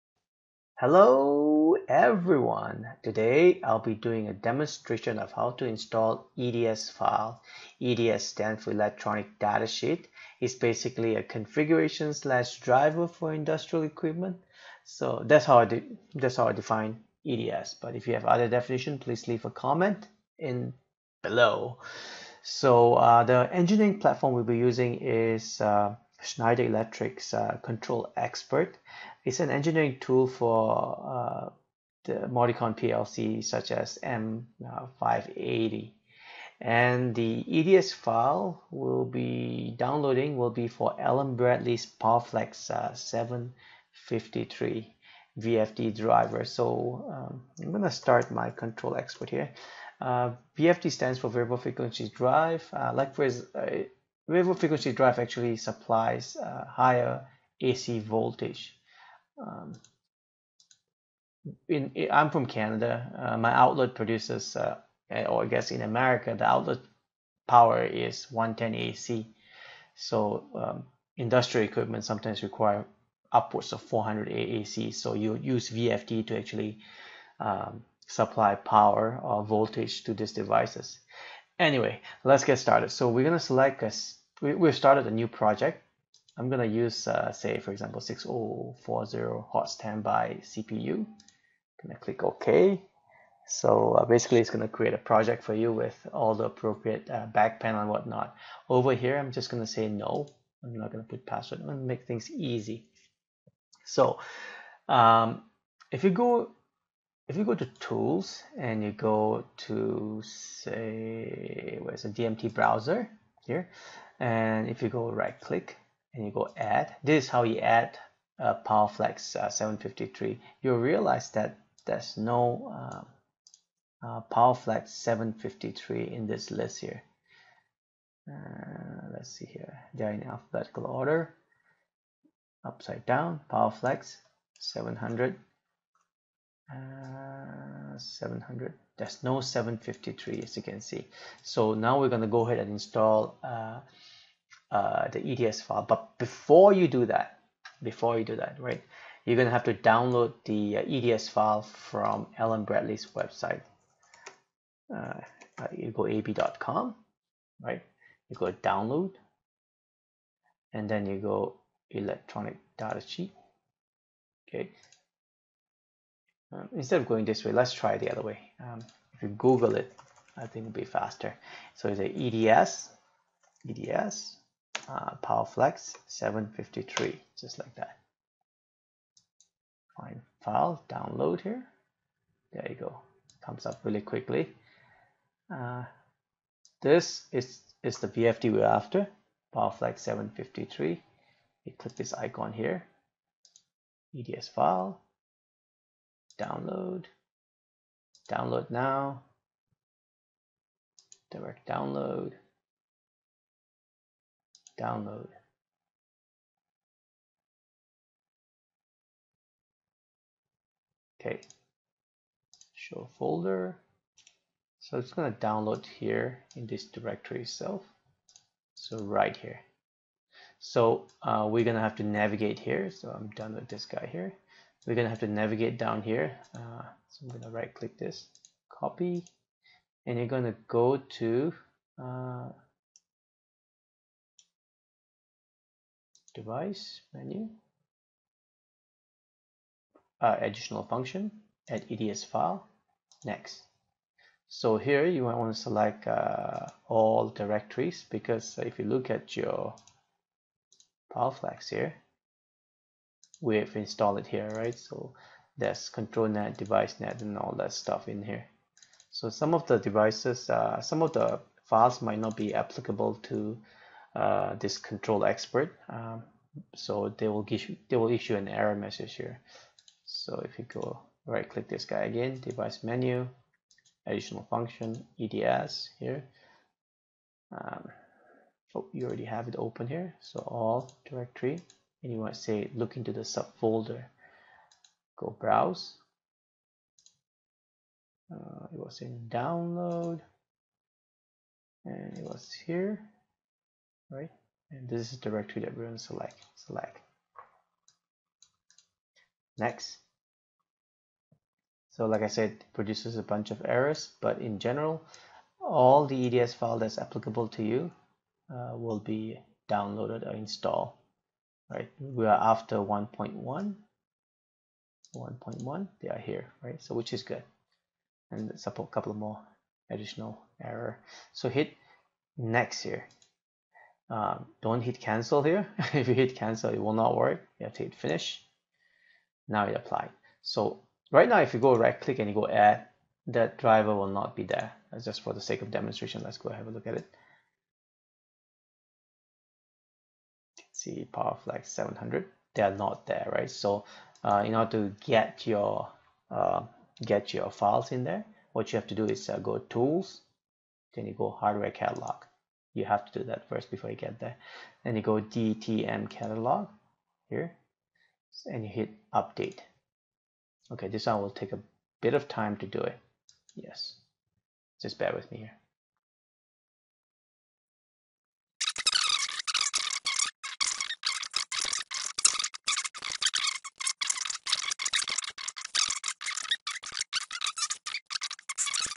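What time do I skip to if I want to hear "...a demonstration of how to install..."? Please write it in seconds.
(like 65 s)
4 s.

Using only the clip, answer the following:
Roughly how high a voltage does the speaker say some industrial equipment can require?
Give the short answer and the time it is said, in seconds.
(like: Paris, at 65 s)
400 AC, at 73 s.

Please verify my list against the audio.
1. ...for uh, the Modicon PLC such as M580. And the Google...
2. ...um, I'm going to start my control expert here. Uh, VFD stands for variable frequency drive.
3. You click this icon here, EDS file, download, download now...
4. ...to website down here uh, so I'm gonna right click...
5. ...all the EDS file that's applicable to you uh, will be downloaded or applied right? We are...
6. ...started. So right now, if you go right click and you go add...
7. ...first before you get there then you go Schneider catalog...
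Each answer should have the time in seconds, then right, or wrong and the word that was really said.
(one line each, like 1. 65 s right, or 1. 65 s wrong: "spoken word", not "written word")
1. 30 s wrong: "EDS", not "Google"
2. 47 s right
3. 191 s right
4. 225 s wrong: "navigate", not "website"
5. 305 s wrong: "installed", not "applied"
6. 329 s wrong: "applied", not "started"
7. 353 s wrong: "DTM", not "Schneider".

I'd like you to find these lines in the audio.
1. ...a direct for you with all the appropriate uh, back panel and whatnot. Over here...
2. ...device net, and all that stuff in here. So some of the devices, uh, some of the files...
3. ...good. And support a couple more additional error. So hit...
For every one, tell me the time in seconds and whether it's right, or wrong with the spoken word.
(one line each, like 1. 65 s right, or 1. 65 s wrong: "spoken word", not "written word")
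1. 94 s wrong: "project", not "direct"
2. 256 s right
3. 317 s right.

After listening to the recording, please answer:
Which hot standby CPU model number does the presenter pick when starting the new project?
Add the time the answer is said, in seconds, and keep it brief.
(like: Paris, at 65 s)
6040, at 88 s.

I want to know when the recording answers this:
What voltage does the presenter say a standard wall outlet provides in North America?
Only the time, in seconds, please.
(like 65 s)
68 s.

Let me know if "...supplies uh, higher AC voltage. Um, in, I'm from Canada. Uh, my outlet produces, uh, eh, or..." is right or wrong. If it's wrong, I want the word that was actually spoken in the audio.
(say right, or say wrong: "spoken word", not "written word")
right.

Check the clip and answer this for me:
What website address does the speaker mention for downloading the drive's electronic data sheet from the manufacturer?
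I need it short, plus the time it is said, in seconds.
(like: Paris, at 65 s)
ab.com, at 156 s.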